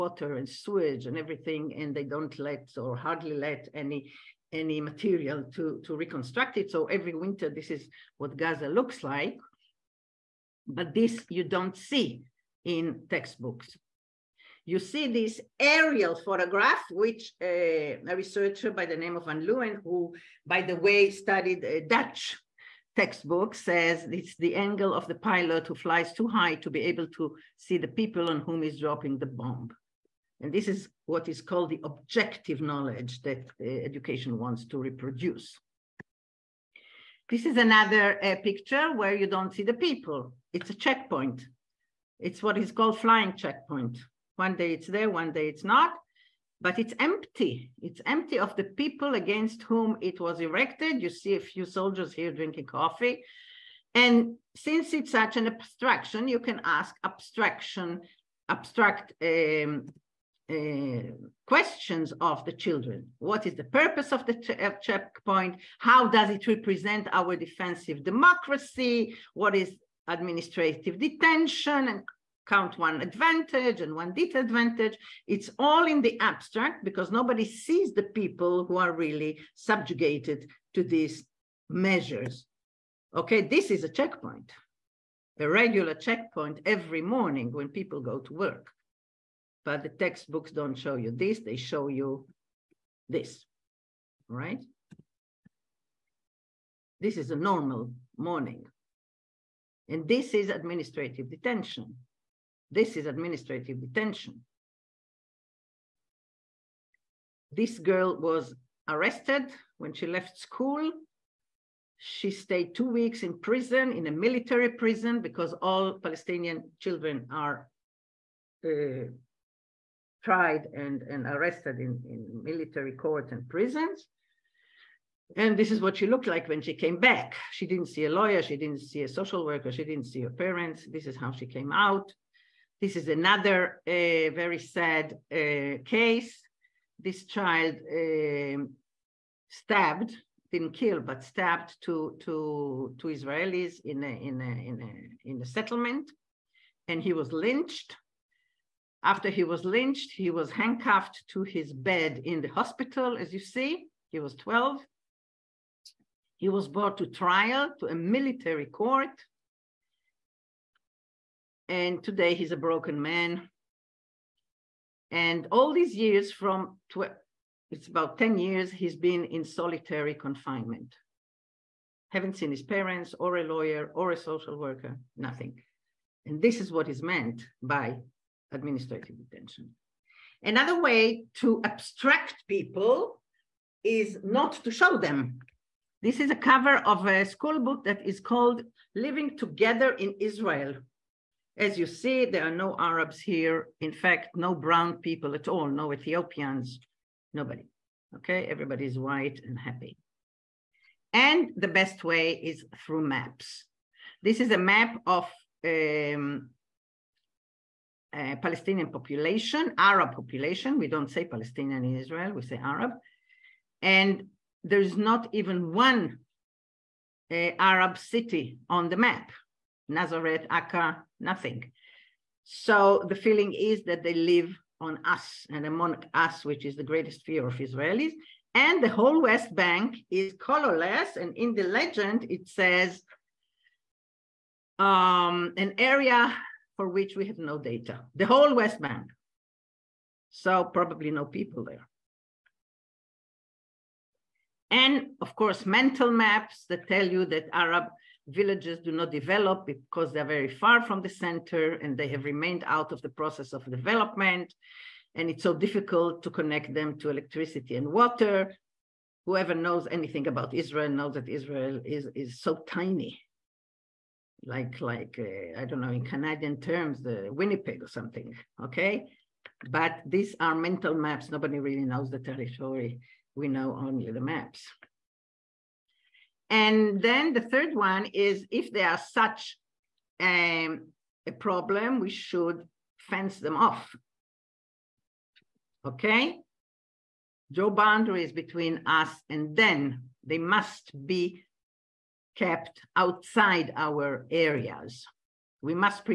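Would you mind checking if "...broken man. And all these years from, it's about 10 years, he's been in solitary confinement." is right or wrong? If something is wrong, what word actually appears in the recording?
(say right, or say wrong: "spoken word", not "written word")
right.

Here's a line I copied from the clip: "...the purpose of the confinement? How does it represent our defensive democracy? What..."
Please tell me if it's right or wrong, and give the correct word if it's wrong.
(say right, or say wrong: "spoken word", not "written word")
wrong: "checkpoint", not "confinement".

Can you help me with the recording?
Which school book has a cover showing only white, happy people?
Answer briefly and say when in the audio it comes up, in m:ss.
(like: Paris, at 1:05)
Living Together in Israel, at 3:08.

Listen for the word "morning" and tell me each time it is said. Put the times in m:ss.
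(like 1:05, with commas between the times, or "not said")
1:27, 1:38.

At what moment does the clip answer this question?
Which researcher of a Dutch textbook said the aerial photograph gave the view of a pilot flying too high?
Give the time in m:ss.
0:19.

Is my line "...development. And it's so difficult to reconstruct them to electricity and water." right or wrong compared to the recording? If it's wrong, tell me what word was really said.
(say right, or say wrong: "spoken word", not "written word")
wrong: "connect", not "reconstruct".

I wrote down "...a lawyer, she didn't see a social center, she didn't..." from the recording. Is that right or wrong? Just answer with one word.
wrong.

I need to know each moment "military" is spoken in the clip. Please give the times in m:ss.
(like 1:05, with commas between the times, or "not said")
1:54, 2:02, 2:37.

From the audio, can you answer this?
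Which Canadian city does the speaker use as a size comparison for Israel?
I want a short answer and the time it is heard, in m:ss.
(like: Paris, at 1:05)
Winnipeg, at 4:27.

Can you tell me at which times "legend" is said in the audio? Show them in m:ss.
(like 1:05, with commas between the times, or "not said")
3:51.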